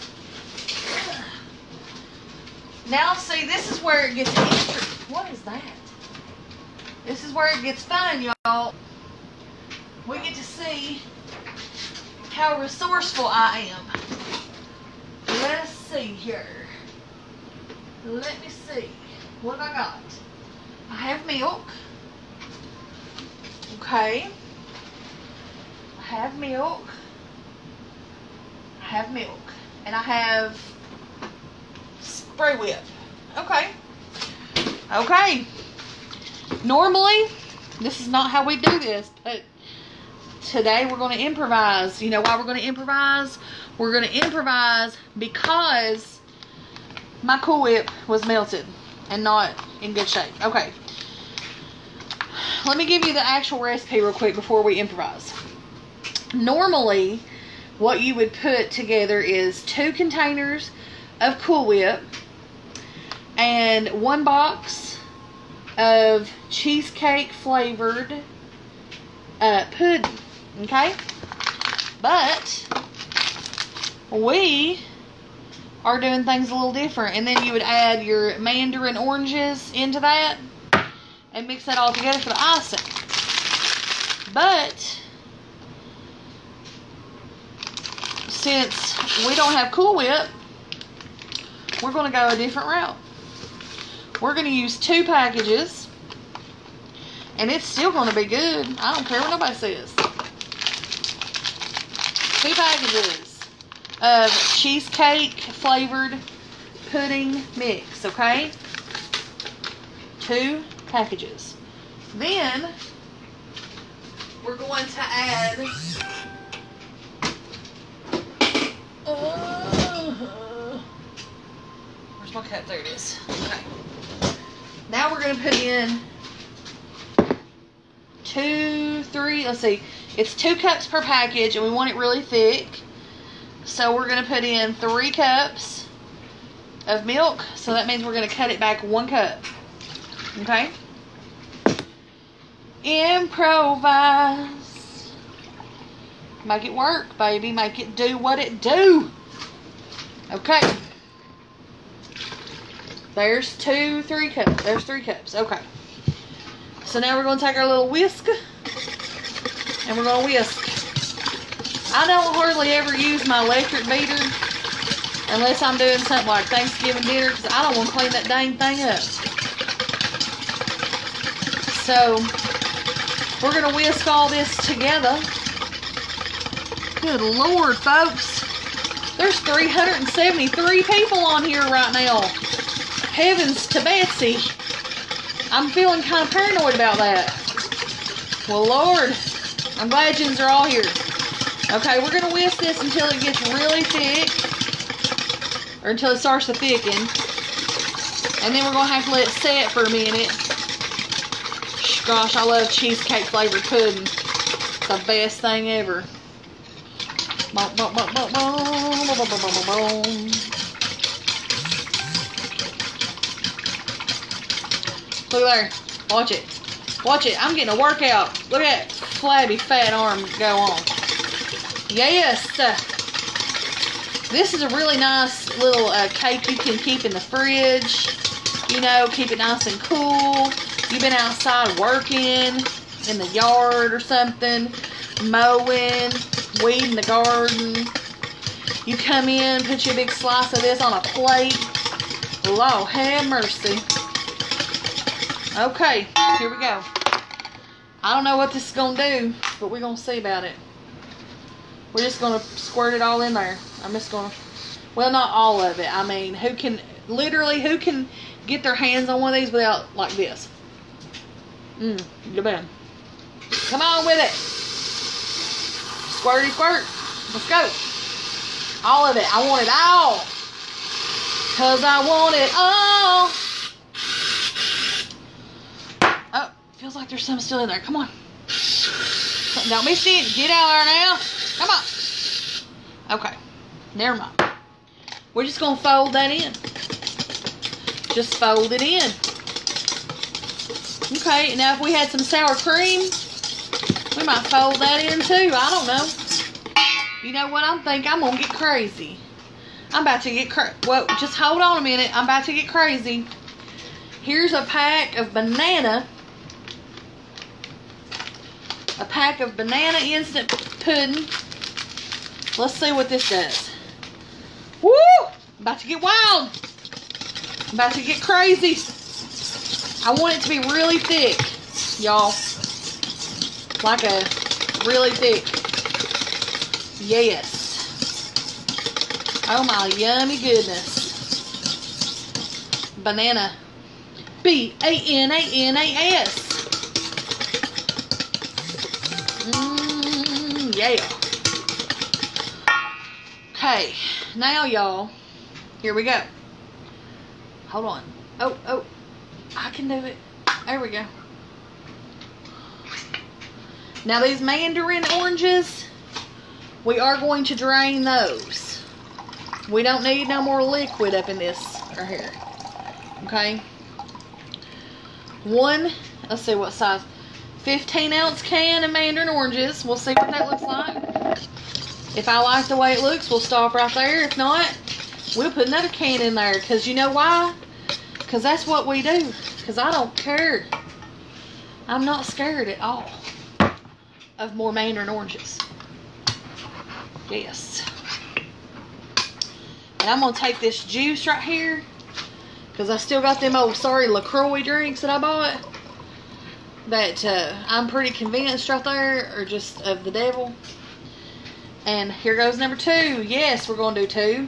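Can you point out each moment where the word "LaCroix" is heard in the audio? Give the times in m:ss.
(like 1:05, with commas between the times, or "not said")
6:34.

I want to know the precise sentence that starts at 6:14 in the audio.
If not, we'll put another can in there.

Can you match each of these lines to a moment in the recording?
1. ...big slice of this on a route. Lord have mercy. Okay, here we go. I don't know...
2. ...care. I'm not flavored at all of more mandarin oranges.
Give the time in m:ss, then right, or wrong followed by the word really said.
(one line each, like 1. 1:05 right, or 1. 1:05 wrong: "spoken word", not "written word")
1. 3:59 wrong: "plate", not "route"
2. 6:20 wrong: "scared", not "flavored".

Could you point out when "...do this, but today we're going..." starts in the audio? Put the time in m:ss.
0:38.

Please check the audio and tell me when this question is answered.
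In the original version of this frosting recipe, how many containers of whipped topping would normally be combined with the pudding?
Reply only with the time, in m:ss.
0:59.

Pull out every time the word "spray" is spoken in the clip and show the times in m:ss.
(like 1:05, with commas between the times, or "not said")
0:32.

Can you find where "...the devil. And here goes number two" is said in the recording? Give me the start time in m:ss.
6:40.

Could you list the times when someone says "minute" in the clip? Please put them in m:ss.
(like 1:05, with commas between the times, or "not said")
3:19, 5:01.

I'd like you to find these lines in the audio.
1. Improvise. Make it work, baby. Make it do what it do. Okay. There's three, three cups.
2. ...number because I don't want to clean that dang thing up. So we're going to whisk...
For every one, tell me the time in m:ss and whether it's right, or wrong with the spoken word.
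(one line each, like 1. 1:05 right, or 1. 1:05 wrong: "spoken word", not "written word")
1. 2:22 wrong: "two", not "three"
2. 2:47 wrong: "dinner", not "number".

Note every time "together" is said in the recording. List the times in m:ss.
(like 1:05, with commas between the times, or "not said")
0:58, 1:21, 2:54.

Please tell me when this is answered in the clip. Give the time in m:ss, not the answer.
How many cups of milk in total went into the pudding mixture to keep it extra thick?
2:14.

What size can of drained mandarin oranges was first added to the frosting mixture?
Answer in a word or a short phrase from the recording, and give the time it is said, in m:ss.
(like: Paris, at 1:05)
15 ounce, at 6:07.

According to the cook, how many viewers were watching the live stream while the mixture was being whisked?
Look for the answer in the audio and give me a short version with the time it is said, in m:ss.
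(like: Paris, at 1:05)
373, at 2:59.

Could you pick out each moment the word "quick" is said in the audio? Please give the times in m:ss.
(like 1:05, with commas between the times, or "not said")
0:54.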